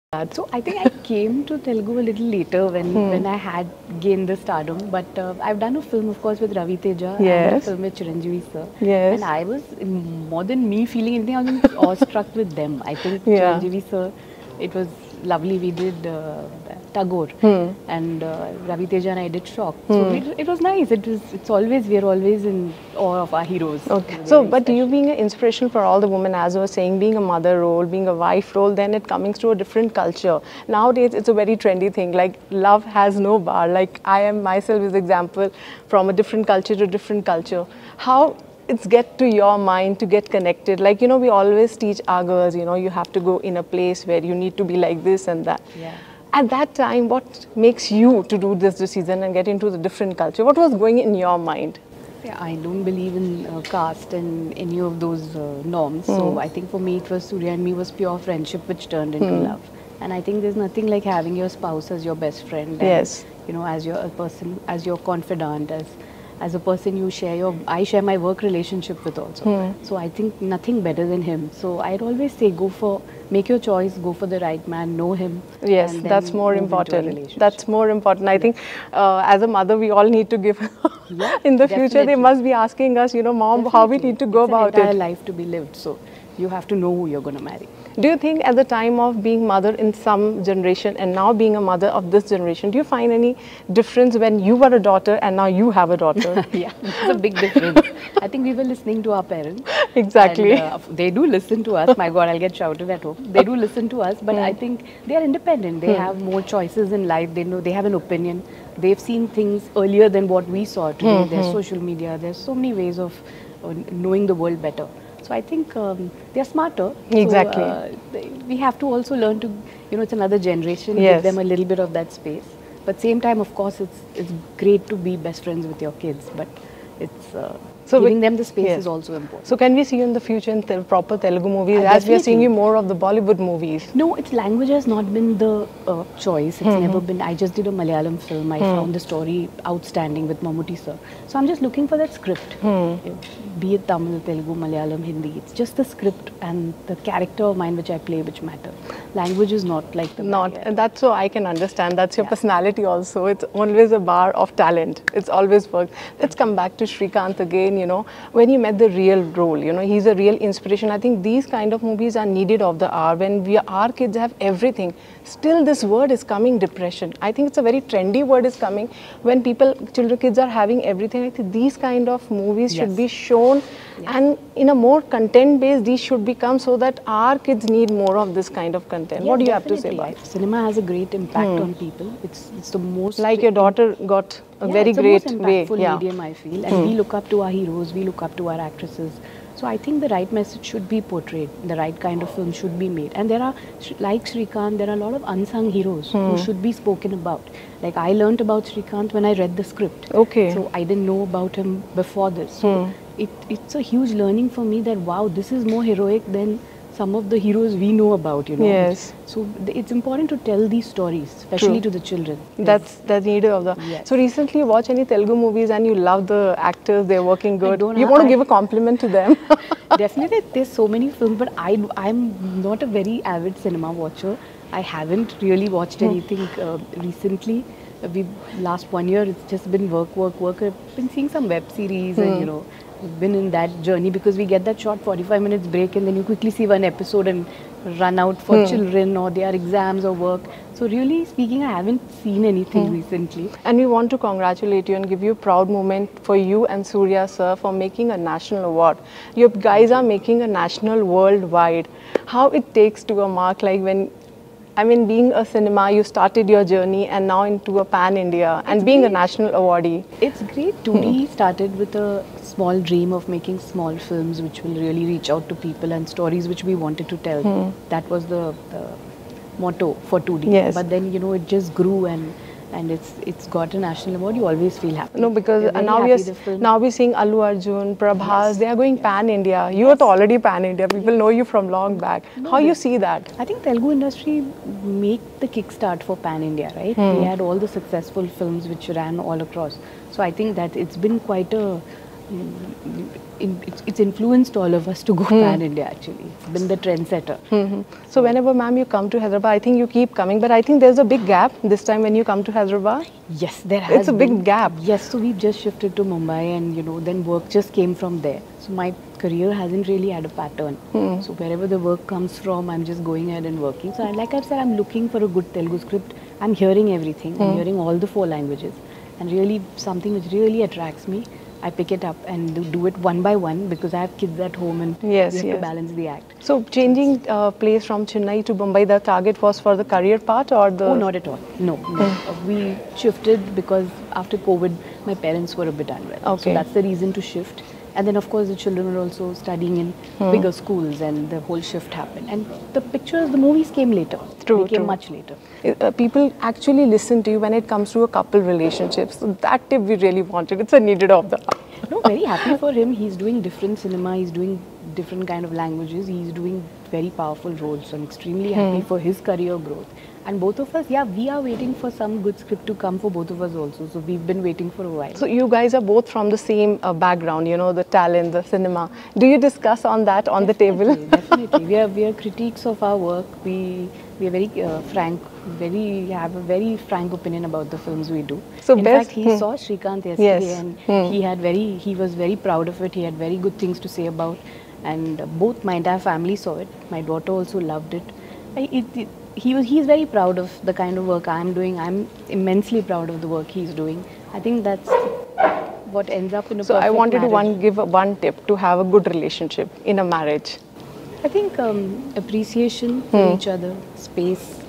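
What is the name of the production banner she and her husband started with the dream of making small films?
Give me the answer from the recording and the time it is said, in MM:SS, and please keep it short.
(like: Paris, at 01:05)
2D, at 04:30.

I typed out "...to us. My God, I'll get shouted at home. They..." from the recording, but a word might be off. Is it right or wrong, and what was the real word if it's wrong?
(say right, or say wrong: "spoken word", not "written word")
right.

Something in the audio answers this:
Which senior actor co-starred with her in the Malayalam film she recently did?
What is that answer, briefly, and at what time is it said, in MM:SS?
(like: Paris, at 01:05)
Mammootty, at 02:20.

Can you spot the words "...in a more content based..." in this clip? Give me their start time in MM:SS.
02:54.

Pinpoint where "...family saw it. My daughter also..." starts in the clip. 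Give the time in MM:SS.
06:26.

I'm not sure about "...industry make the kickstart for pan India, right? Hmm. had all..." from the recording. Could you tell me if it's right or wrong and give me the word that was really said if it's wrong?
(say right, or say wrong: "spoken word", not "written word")
right.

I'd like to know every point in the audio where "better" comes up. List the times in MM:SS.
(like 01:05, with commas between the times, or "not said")
01:10, 01:54.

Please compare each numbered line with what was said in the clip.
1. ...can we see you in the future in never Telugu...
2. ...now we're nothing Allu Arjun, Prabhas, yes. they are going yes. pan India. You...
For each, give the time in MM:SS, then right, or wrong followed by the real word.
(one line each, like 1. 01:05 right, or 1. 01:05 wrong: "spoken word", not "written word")
1. 02:09 wrong: "proper", not "never"
2. 04:36 wrong: "seeing", not "nothing".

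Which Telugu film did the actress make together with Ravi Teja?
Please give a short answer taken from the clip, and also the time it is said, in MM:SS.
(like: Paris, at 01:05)
Shock, at 00:19.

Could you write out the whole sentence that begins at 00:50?
What was going in your mind?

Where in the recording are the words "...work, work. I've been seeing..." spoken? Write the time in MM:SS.
03:50.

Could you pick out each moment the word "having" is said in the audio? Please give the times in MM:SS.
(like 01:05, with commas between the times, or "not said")
01:01, 02:50.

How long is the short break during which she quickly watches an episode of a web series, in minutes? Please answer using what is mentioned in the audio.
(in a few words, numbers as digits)
45 minutes.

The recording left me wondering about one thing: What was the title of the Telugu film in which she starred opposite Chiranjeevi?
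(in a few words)
Tagore.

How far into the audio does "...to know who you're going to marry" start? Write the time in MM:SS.
01:26.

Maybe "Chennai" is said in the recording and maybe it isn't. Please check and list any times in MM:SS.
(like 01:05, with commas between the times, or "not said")
05:28.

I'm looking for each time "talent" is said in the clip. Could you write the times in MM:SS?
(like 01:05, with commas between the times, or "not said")
02:34, 06:07.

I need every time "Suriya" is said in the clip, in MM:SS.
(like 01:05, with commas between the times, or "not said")
00:57, 04:06.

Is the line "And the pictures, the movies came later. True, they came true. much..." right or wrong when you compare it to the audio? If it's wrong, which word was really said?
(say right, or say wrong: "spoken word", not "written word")
right.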